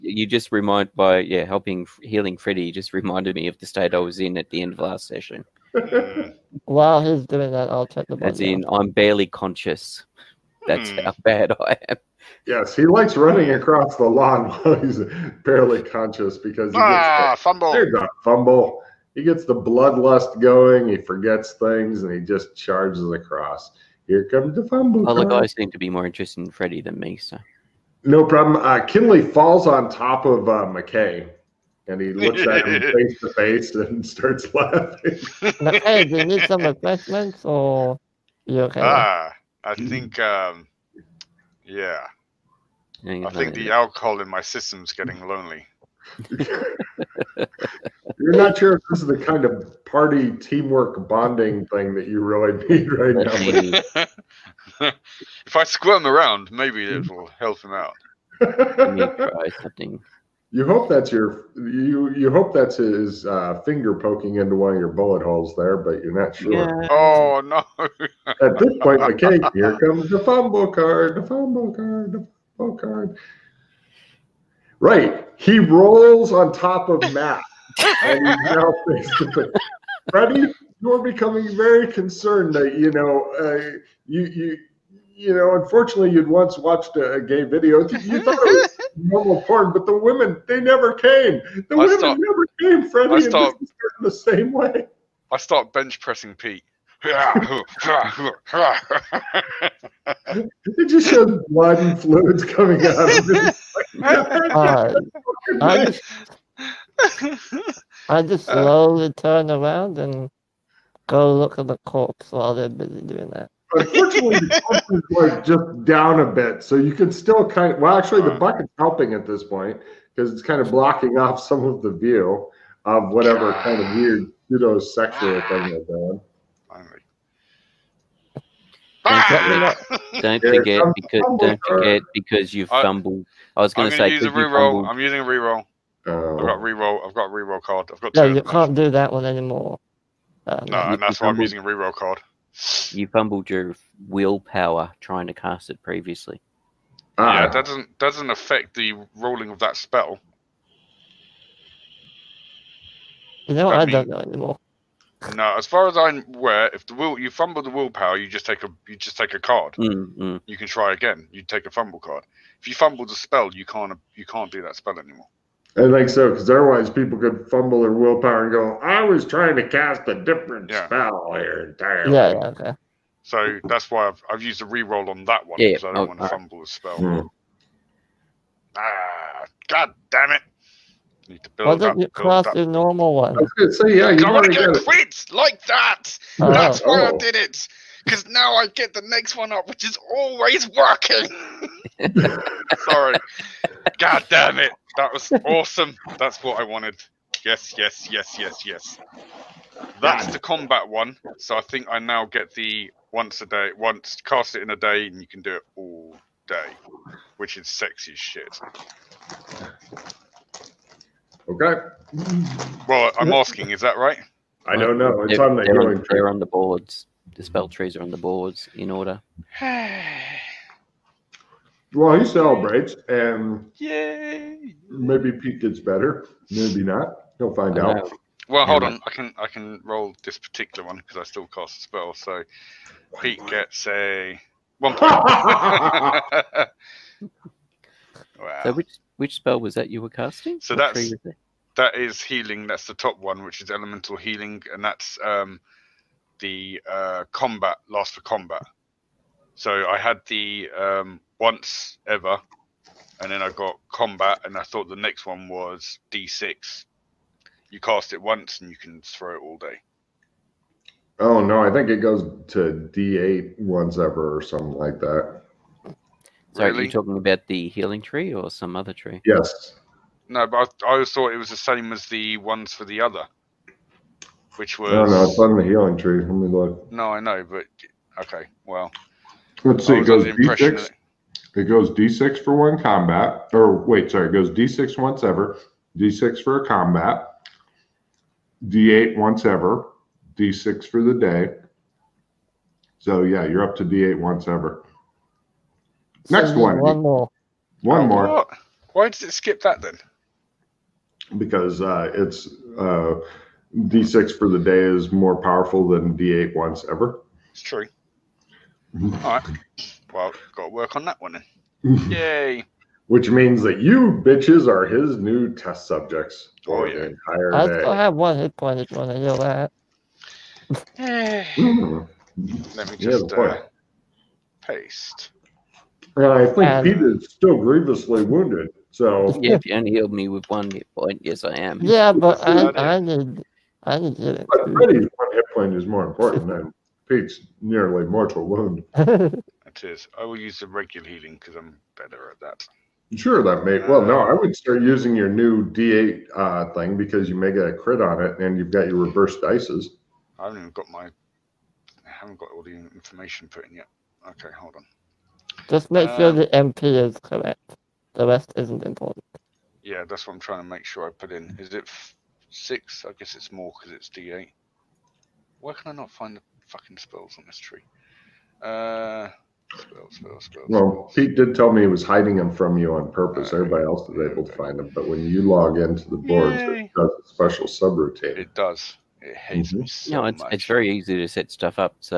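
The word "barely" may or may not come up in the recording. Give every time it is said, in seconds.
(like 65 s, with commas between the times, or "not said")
8 s, 15 s.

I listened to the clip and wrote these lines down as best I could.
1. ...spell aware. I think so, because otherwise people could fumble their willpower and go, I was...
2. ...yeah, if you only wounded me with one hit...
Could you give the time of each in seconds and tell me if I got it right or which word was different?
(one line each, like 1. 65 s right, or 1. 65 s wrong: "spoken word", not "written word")
1. 164 s wrong: "anymore", not "aware"
2. 329 s wrong: "healed", not "wounded".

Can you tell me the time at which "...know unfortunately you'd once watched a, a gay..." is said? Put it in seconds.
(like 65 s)
85 s.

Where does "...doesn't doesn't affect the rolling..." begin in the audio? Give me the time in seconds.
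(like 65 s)
147 s.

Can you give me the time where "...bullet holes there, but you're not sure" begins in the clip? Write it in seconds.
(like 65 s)
64 s.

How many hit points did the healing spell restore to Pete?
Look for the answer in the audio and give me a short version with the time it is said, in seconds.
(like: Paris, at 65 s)
1, at 234 s.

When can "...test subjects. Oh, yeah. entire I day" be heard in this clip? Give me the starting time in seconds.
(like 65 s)
315 s.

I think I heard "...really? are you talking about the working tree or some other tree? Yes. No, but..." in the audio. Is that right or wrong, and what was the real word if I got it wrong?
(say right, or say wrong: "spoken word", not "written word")
wrong: "healing", not "working".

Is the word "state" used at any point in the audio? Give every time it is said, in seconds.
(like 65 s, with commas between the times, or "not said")
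3 s.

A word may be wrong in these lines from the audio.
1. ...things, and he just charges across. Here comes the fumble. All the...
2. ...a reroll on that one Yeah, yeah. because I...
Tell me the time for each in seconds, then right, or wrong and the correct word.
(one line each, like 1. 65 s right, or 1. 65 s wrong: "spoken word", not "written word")
1. 21 s right
2. 174 s right.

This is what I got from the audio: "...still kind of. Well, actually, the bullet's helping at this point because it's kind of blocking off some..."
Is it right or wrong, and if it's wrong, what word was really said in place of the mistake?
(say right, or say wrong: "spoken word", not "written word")
wrong: "bucket", not "bullet".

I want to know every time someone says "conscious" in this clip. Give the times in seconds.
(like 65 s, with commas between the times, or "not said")
9 s, 15 s.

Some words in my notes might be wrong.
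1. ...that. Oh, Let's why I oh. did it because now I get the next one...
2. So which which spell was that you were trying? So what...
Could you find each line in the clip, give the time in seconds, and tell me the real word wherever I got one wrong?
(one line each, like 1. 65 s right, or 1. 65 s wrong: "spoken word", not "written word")
1. 185 s wrong: "That", not "Let"
2. 238 s wrong: "casting", not "trying".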